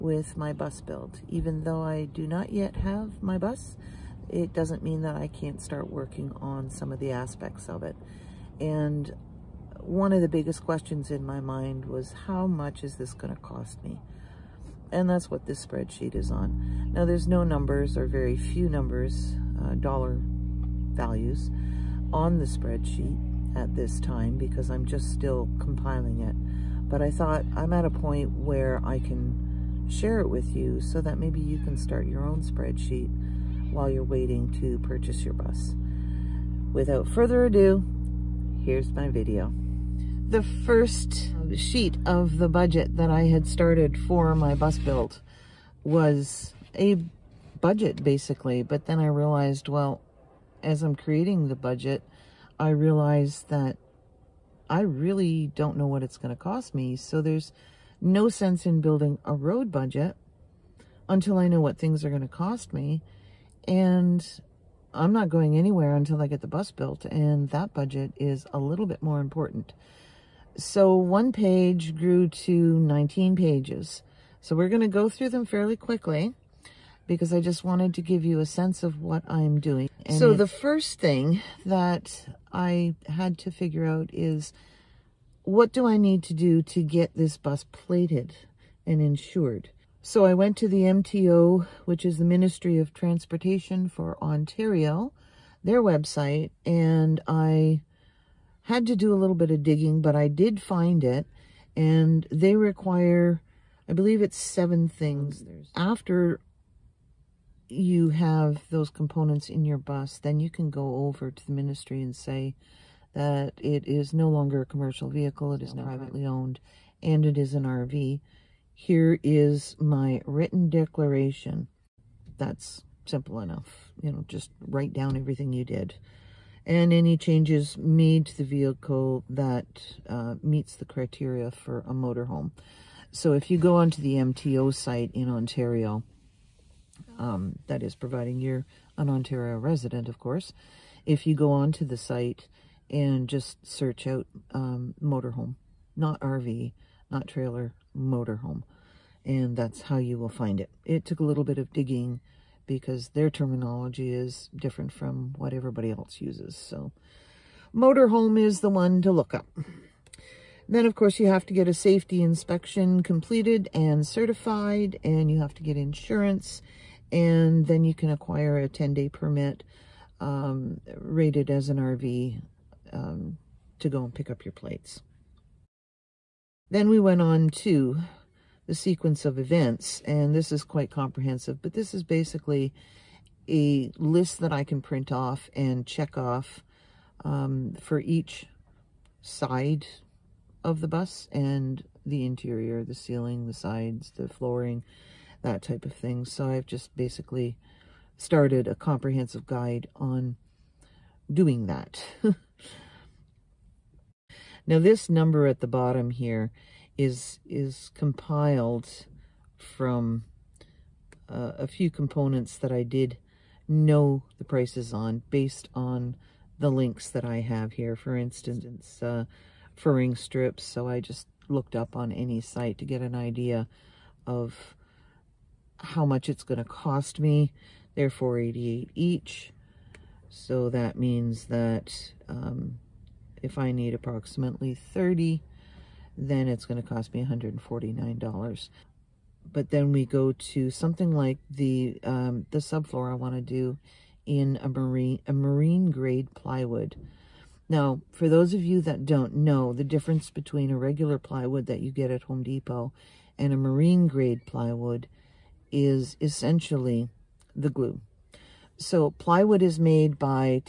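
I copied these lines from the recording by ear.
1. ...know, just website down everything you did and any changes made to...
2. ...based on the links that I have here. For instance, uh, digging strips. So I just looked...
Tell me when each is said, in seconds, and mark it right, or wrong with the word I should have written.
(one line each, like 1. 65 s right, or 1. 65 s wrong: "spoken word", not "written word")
1. 124 s wrong: "write", not "website"
2. 215 s wrong: "furring", not "digging".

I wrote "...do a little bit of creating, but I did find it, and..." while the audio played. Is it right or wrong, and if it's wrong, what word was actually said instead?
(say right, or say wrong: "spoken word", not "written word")
wrong: "digging", not "creating".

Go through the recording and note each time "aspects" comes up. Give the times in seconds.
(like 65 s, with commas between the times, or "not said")
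7 s.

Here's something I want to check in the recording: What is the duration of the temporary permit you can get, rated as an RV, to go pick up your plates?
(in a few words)
10-day.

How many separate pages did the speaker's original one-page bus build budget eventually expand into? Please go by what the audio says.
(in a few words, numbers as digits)
19.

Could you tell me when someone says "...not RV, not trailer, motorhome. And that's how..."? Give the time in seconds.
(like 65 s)
145 s.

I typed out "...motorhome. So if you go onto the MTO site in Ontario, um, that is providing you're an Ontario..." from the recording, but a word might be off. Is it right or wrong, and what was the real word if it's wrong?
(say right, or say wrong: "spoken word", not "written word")
right.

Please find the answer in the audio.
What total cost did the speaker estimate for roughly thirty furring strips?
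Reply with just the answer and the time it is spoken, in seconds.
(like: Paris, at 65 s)
$149, at 237 s.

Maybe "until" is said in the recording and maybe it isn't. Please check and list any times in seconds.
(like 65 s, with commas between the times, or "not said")
61 s, 65 s.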